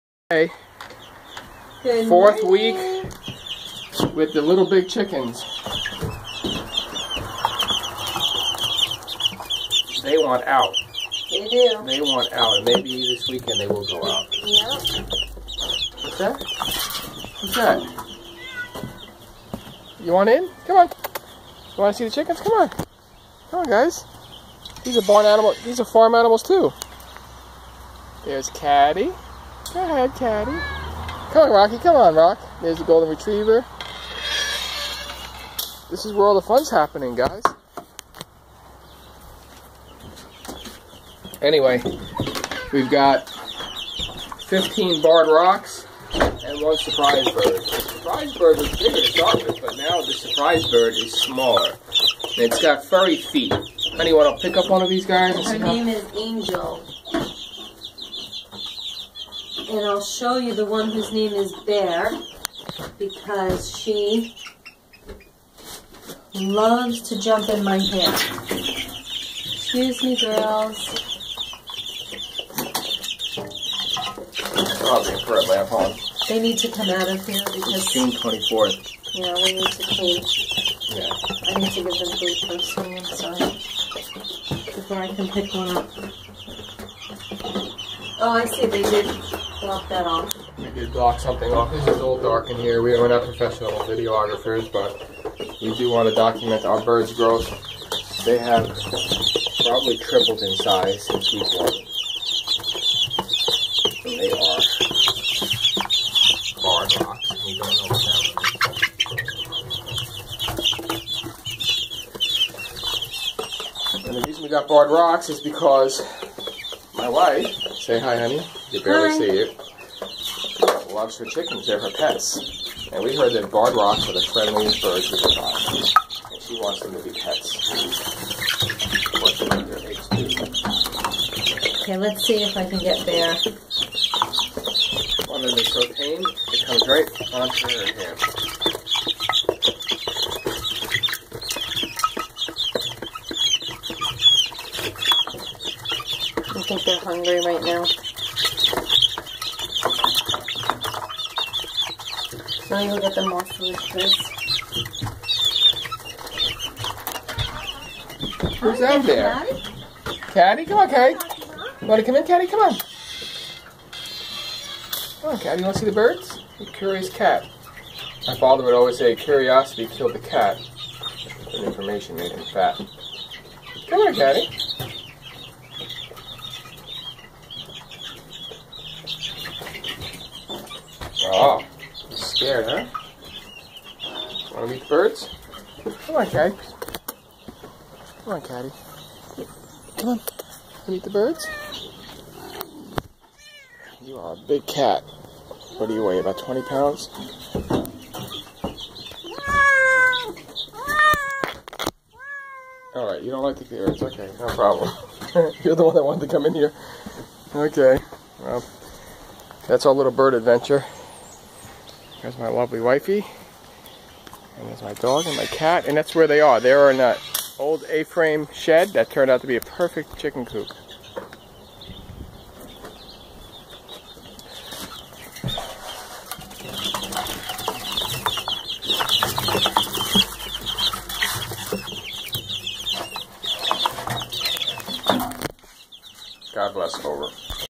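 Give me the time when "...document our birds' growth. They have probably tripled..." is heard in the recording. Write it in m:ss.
1:36.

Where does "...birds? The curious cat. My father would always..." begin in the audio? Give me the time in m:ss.
2:45.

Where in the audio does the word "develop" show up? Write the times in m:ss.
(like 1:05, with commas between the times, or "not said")
not said.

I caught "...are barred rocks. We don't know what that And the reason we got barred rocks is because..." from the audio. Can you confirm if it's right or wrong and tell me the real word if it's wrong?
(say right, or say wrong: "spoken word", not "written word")
right.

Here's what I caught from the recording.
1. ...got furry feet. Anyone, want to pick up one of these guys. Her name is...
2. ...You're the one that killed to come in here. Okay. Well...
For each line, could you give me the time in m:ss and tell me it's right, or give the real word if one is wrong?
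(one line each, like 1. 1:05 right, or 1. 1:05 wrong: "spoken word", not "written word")
1. 0:52 right
2. 3:25 wrong: "wanted", not "killed".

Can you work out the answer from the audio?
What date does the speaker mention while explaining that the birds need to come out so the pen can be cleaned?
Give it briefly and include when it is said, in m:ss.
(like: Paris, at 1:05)
June 24th, at 1:17.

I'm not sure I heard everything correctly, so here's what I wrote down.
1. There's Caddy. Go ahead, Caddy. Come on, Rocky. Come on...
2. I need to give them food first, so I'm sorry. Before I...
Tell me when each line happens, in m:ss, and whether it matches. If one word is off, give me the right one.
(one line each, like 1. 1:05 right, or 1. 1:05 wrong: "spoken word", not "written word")
1. 0:28 right
2. 1:21 right.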